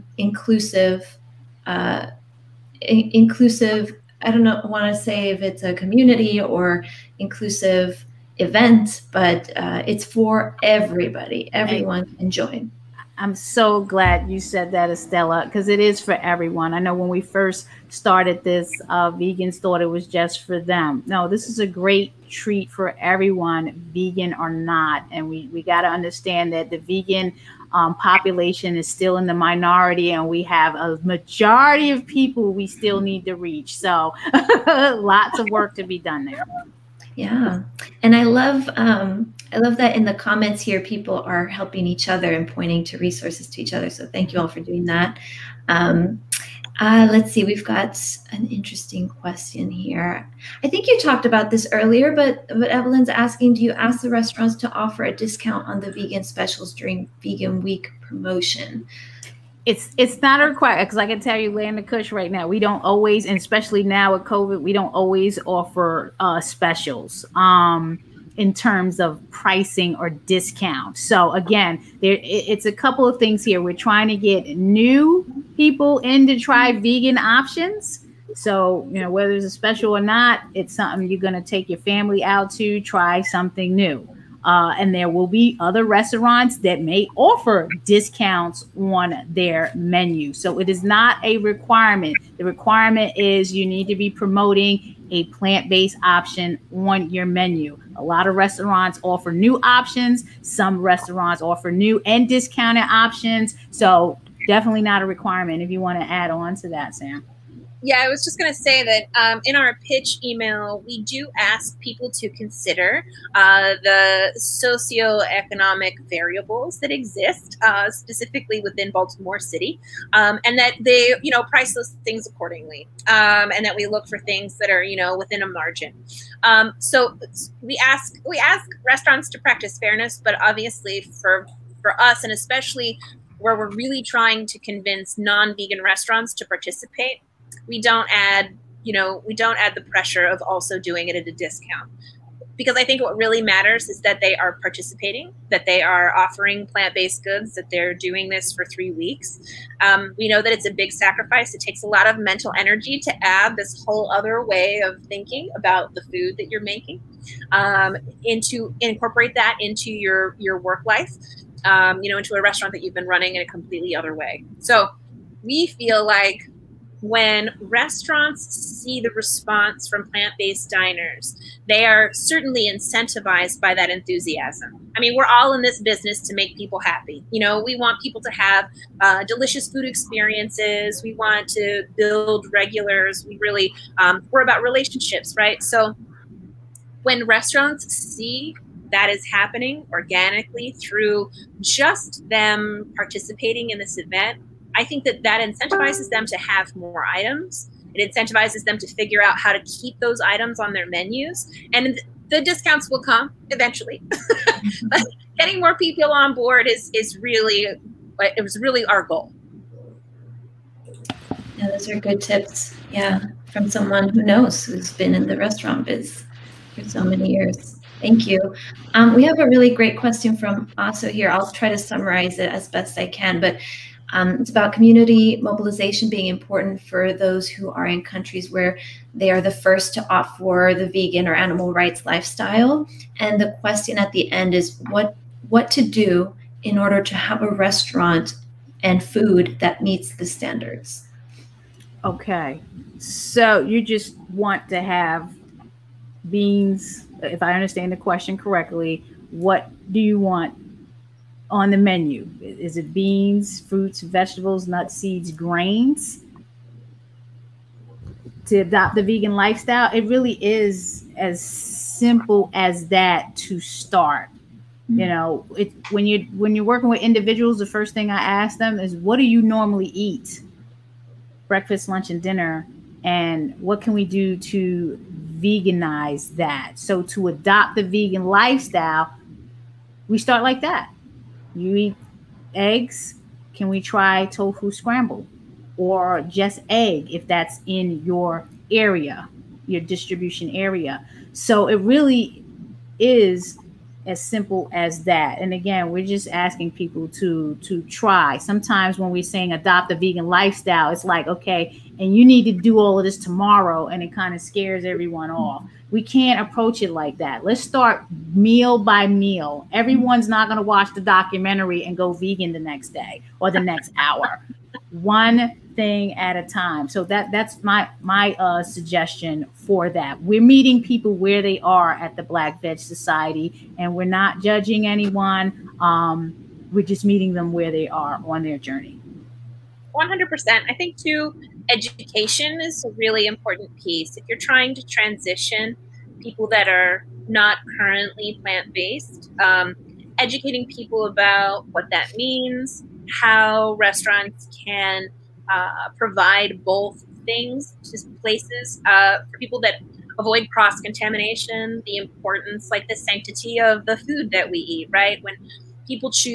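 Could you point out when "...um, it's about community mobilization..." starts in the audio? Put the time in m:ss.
3:44.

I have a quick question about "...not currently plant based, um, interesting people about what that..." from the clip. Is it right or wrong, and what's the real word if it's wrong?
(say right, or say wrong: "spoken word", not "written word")
wrong: "educating", not "interesting".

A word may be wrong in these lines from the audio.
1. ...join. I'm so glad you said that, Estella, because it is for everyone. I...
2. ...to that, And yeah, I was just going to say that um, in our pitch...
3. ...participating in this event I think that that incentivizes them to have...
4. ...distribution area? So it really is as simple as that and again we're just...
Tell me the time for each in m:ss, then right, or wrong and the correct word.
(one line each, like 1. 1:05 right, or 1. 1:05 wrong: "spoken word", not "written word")
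1. 0:12 right
2. 1:46 wrong: "Sam", not "And"
3. 3:12 right
4. 4:49 right.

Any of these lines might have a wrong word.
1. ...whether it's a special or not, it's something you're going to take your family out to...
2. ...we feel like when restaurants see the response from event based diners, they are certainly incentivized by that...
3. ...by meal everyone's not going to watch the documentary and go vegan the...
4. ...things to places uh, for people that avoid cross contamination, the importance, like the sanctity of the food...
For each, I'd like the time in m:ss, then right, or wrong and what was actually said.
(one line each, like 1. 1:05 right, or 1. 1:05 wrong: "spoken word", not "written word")
1. 1:19 right
2. 2:45 wrong: "plant", not "event"
3. 5:08 right
4. 5:47 right.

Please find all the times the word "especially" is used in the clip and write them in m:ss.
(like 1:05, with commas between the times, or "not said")
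1:03, 2:12.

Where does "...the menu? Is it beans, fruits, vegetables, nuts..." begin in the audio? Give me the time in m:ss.
4:11.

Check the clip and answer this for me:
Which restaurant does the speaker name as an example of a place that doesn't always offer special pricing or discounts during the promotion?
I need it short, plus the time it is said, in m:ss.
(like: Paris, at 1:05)
Land of Kush, at 1:01.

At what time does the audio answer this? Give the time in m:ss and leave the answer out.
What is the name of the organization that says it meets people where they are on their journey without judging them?
5:22.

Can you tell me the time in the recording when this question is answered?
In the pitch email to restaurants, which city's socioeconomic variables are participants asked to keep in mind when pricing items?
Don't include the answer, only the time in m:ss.
1:58.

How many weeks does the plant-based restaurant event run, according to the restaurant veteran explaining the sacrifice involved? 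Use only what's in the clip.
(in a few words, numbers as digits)
3.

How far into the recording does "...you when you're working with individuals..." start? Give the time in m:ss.
4:26.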